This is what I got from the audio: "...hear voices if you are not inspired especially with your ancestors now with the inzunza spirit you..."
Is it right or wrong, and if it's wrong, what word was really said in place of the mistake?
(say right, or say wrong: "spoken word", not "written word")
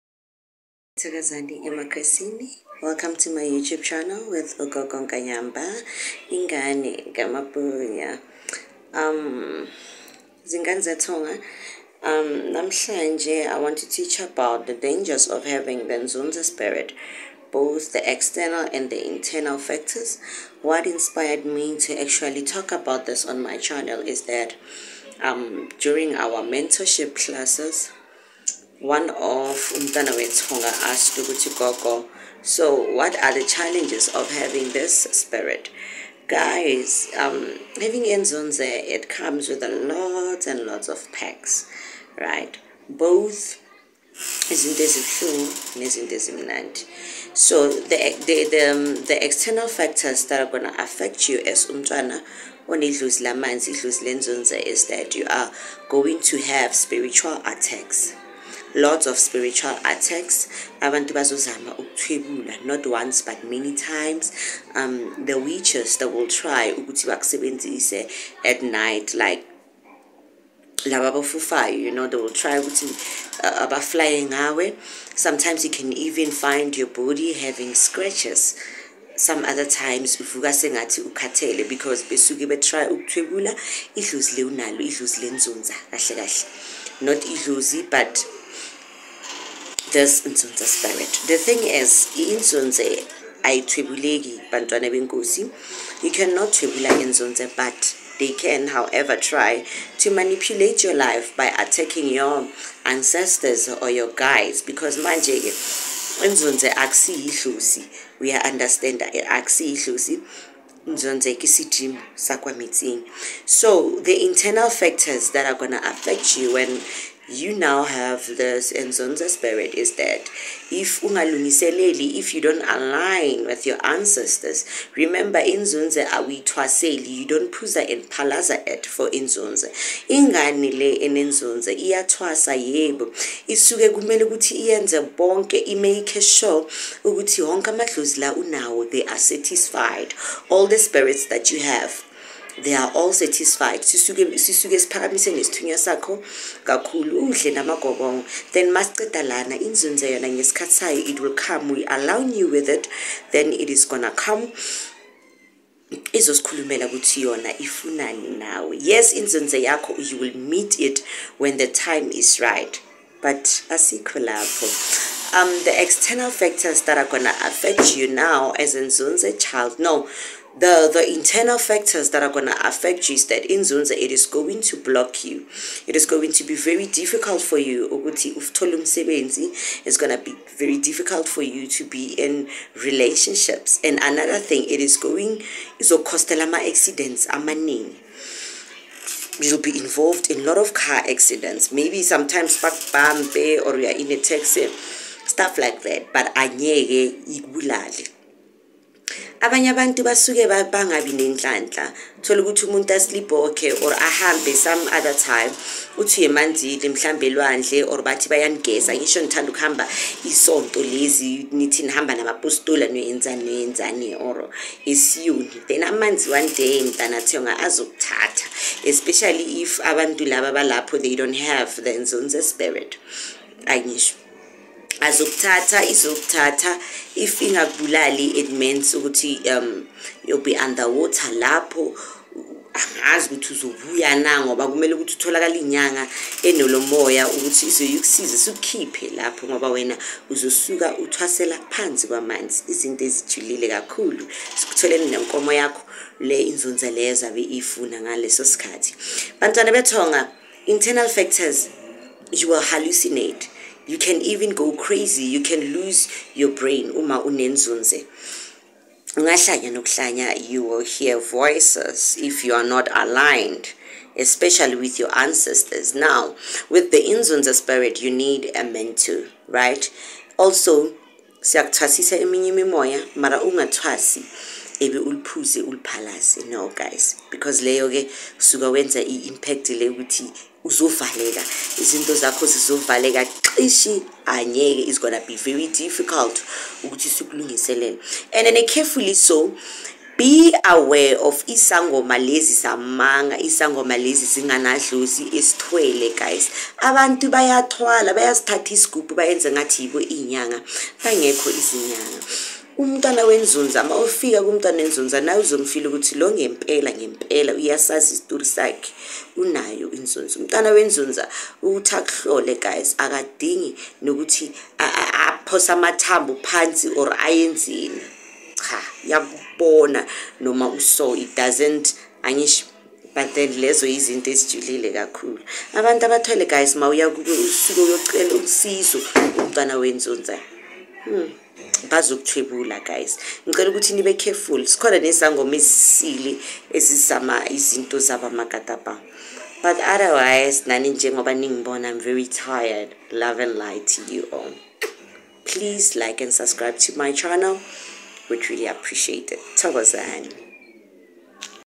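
wrong: "aligned", not "inspired".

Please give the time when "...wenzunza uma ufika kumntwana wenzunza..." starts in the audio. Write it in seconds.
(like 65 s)
303 s.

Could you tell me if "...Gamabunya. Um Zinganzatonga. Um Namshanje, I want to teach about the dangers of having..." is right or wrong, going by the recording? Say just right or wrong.
right.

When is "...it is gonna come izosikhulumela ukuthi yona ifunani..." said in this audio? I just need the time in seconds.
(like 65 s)
153 s.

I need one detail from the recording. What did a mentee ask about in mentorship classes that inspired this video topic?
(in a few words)
the challenges.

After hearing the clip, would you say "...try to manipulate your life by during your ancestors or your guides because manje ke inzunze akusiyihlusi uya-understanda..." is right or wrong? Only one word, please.
wrong.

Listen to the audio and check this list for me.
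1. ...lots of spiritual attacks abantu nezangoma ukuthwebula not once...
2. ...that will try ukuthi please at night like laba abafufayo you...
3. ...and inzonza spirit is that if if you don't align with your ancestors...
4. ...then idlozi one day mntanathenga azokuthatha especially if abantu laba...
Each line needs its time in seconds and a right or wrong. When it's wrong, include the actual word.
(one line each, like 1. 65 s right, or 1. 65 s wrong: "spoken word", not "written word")
1. 58 s wrong: "bazozama", not "nezangoma"
2. 65 s wrong: "bakusebenzise", not "please"
3. 118 s wrong: "zonza", not "inzonza"
4. 215 s wrong: "amanzi", not "idlozi".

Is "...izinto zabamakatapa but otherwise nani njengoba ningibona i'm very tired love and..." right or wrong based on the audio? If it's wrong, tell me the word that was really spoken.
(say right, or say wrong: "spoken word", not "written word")
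right.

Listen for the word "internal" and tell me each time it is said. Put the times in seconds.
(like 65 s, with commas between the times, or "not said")
19 s, 114 s, 171 s, 250 s.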